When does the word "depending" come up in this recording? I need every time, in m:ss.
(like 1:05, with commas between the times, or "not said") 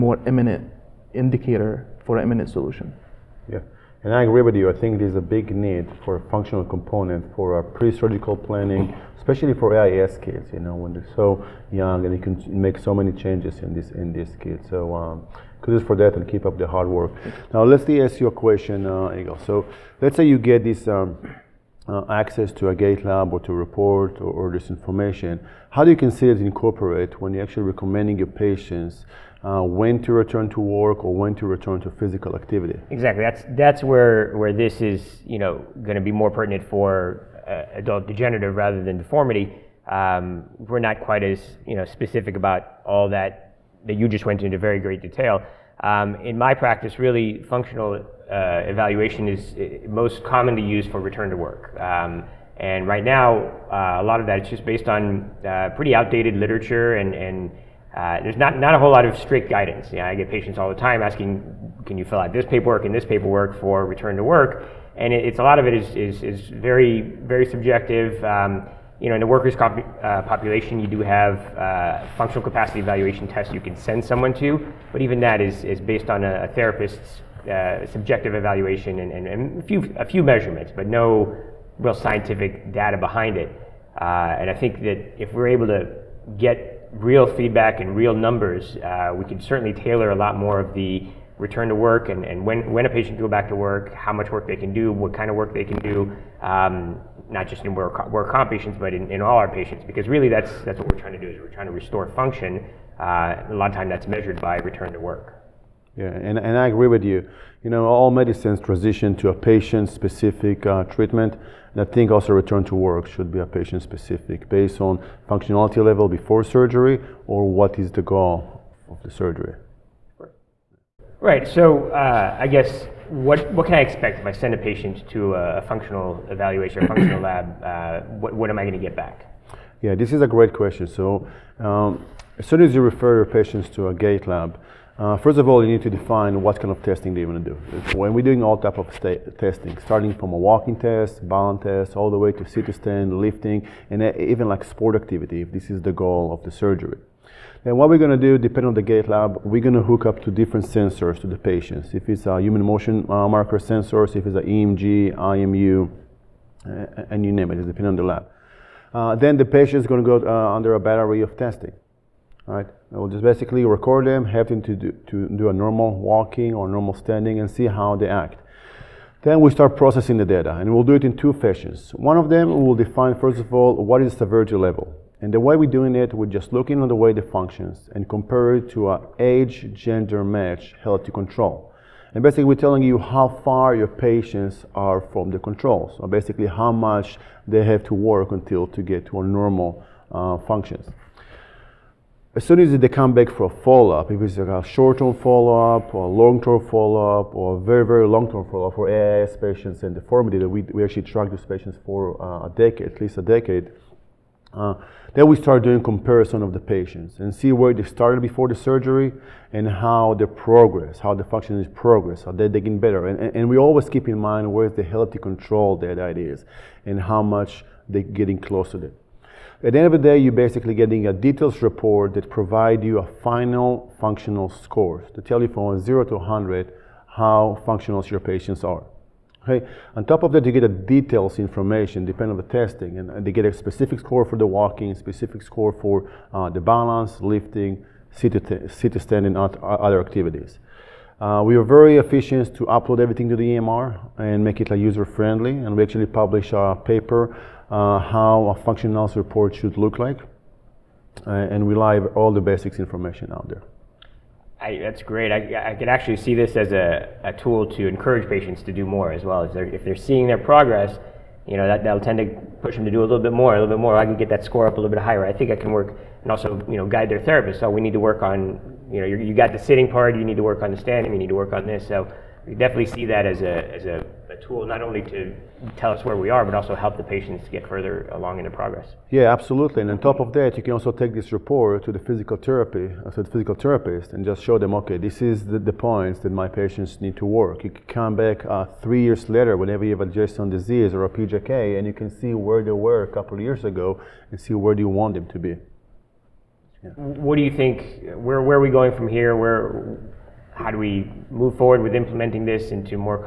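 2:28, 2:37, 3:52.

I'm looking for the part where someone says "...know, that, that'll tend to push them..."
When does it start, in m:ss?
4:21.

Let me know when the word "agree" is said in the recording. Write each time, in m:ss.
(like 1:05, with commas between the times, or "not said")
0:04, 1:46.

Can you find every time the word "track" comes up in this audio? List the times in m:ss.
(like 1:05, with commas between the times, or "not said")
3:21.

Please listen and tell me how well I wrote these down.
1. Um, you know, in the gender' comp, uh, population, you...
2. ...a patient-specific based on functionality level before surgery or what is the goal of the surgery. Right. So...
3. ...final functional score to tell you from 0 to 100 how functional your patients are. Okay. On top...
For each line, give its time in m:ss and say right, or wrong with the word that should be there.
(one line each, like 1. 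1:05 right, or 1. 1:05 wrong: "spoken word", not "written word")
1. 1:08 wrong: "workers", not "gender"
2. 1:53 right
3. 3:43 right.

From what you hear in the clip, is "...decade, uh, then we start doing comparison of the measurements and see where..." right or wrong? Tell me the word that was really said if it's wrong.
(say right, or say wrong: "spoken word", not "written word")
wrong: "patients", not "measurements".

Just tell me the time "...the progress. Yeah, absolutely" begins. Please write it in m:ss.
4:38.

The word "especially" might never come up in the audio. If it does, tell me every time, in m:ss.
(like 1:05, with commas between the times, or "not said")
0:09.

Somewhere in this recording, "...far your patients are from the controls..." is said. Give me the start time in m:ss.
3:03.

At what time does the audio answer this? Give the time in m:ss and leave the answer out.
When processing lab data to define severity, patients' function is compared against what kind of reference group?
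2:59.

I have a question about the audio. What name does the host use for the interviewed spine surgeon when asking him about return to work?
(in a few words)
Yigal.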